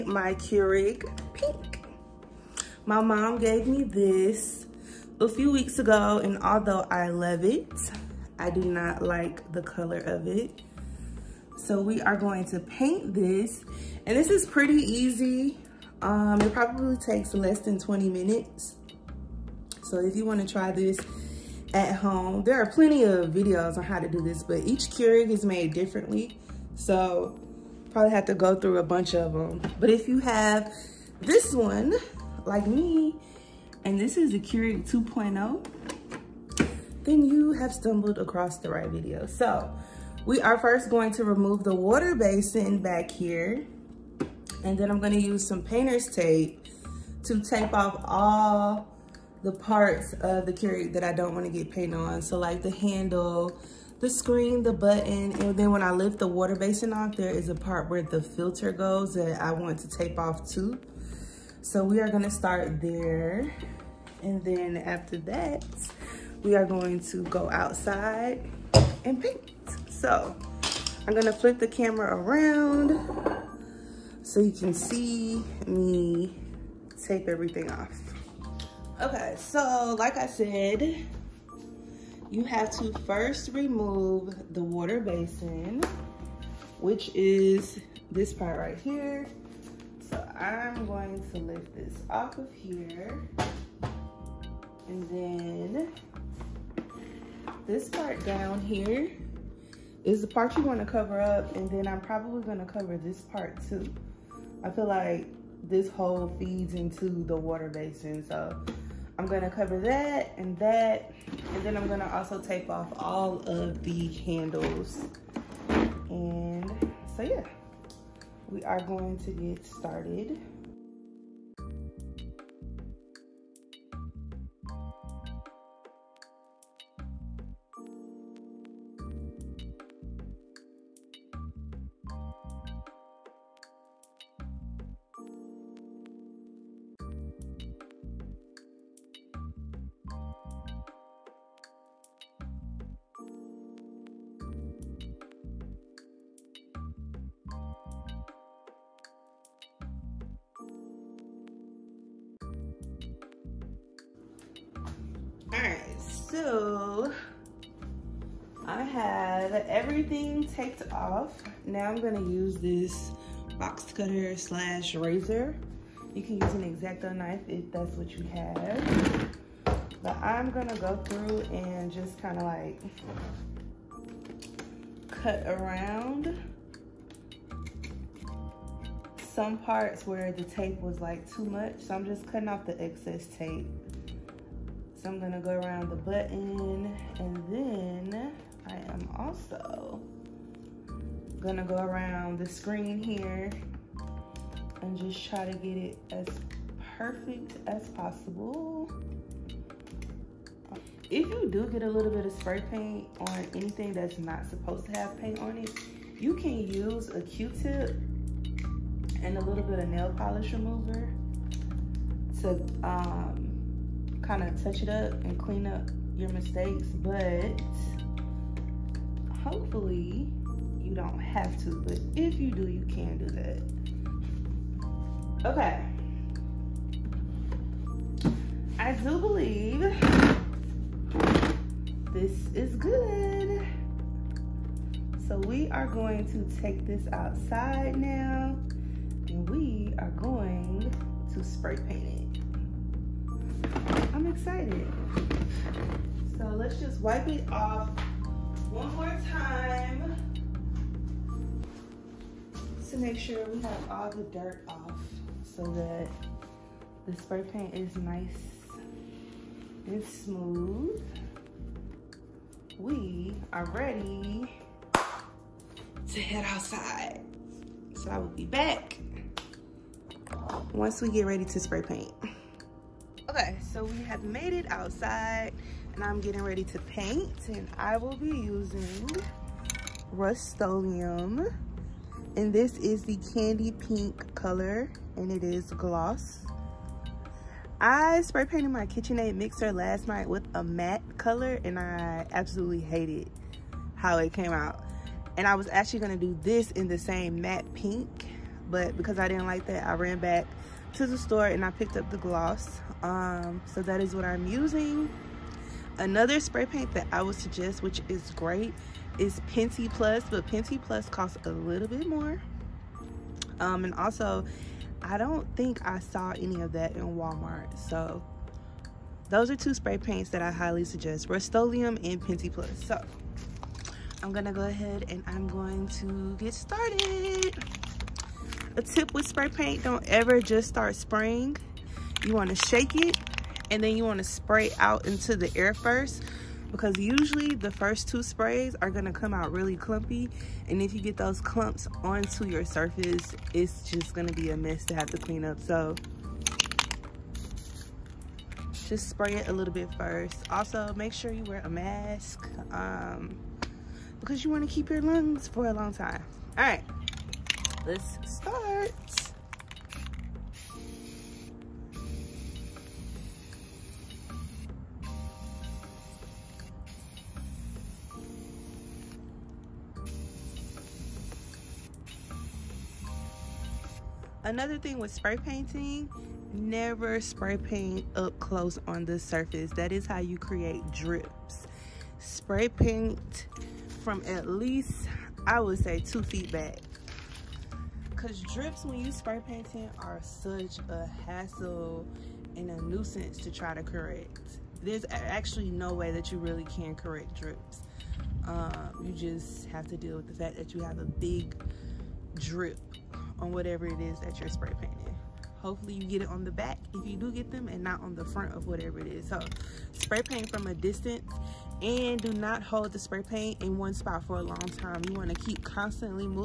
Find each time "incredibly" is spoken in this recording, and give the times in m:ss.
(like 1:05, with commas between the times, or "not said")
not said.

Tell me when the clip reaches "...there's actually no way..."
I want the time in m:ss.
6:34.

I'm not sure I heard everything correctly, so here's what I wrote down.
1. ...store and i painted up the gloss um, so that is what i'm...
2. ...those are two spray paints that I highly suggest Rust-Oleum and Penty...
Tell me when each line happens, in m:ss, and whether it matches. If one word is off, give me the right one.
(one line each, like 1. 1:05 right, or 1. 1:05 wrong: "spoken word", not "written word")
1. 5:01 wrong: "picked", not "painted"
2. 5:19 right.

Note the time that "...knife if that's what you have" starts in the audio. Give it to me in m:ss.
2:47.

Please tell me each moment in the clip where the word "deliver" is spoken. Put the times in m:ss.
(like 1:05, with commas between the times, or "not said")
not said.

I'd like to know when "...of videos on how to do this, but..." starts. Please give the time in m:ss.
0:23.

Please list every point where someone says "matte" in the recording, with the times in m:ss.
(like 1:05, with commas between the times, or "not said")
4:50, 4:57.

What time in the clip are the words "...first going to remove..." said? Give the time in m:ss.
0:40.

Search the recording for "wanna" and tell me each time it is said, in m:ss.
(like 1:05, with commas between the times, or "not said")
0:20, 0:51.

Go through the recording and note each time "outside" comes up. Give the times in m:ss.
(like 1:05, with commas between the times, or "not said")
1:07, 3:57, 4:26, 4:34.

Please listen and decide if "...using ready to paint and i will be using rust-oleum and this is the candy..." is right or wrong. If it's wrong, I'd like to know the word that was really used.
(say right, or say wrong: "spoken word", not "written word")
wrong: "getting", not "using".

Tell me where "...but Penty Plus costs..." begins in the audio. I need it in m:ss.
5:10.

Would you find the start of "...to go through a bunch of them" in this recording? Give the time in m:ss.
0:28.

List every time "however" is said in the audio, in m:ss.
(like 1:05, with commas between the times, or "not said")
not said.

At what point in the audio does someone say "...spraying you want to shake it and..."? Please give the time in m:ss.
5:30.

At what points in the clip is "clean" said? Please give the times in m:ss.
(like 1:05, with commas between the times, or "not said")
3:35, 5:45.